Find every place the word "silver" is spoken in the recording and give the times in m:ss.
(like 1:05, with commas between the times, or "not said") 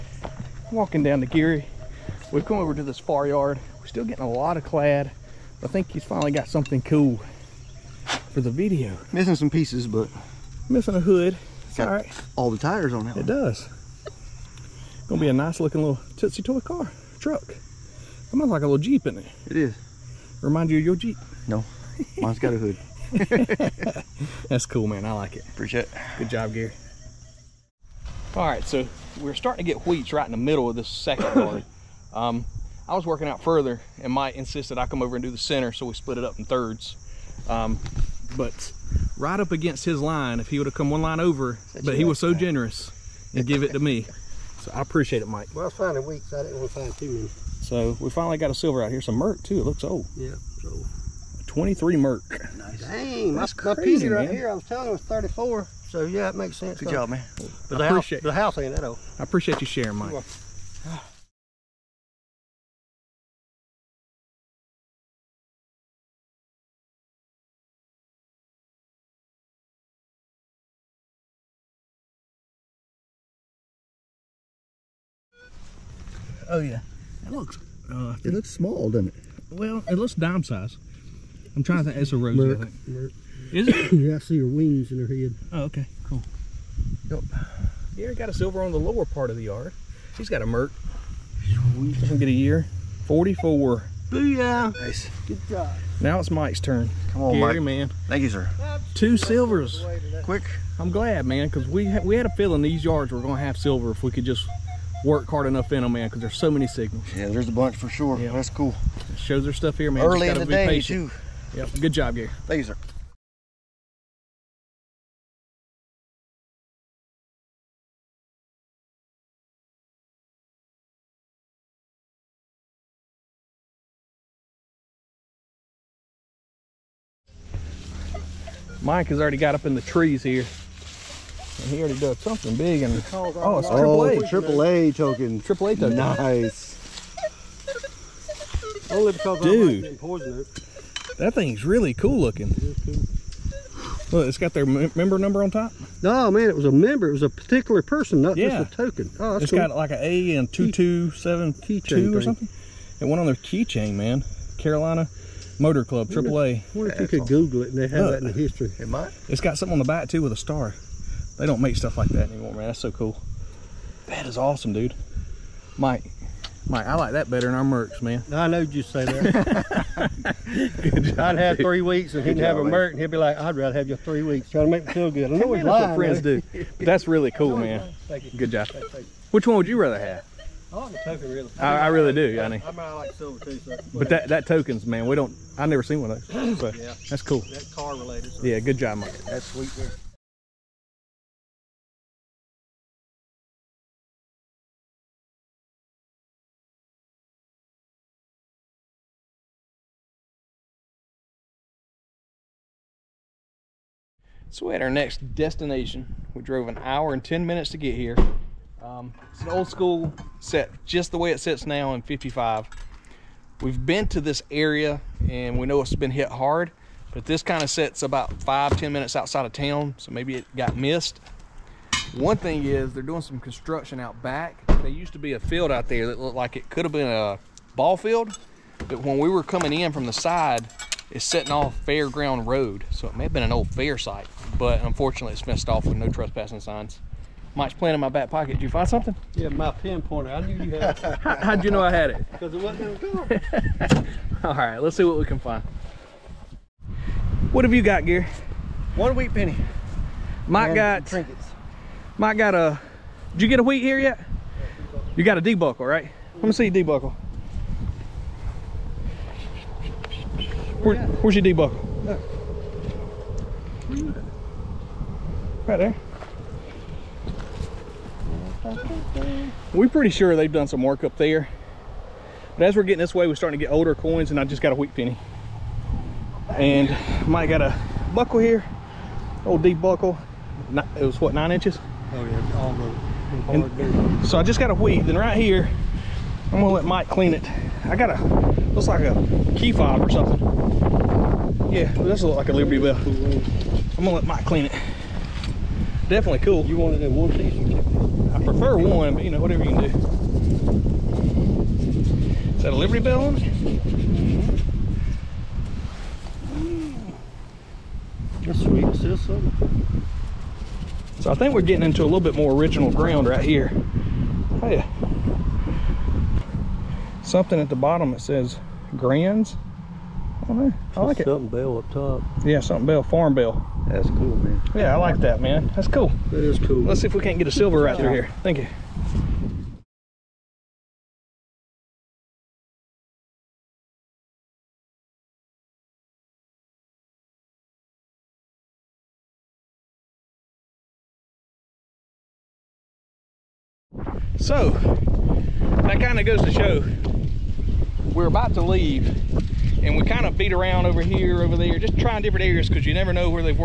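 0:48, 1:28, 1:39, 1:43, 3:03, 5:27.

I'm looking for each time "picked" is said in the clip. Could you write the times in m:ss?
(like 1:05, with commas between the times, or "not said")
not said.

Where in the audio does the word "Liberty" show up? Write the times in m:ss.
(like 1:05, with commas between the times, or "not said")
4:52, 5:02.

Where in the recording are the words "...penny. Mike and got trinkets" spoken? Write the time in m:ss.
4:09.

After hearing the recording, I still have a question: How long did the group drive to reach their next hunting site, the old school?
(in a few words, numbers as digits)
1 hour 10 minutes.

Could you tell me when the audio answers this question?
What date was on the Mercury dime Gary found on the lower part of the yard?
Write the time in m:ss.
1:33.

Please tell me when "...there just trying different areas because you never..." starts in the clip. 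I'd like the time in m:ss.
5:51.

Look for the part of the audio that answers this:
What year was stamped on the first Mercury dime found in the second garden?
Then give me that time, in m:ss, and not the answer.
0:51.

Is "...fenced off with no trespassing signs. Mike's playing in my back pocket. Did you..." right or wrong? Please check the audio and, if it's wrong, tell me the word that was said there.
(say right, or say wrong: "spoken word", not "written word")
right.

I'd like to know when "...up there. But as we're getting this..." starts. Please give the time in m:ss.
4:31.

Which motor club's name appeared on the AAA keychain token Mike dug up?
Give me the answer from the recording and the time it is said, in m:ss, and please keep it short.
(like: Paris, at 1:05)
Carolina Motor Club, at 2:34.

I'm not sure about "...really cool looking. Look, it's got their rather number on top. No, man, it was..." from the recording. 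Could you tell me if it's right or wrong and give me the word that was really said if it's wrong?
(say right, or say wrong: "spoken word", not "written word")
wrong: "member", not "rather".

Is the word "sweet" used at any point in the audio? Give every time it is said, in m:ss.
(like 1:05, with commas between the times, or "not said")
1:31, 3:09, 5:08.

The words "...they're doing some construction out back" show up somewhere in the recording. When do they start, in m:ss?
3:42.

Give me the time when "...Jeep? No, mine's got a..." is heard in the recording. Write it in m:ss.
0:20.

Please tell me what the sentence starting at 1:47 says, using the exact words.
Yeah, there's a bunch for sure.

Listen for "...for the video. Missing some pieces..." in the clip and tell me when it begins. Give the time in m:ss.
0:08.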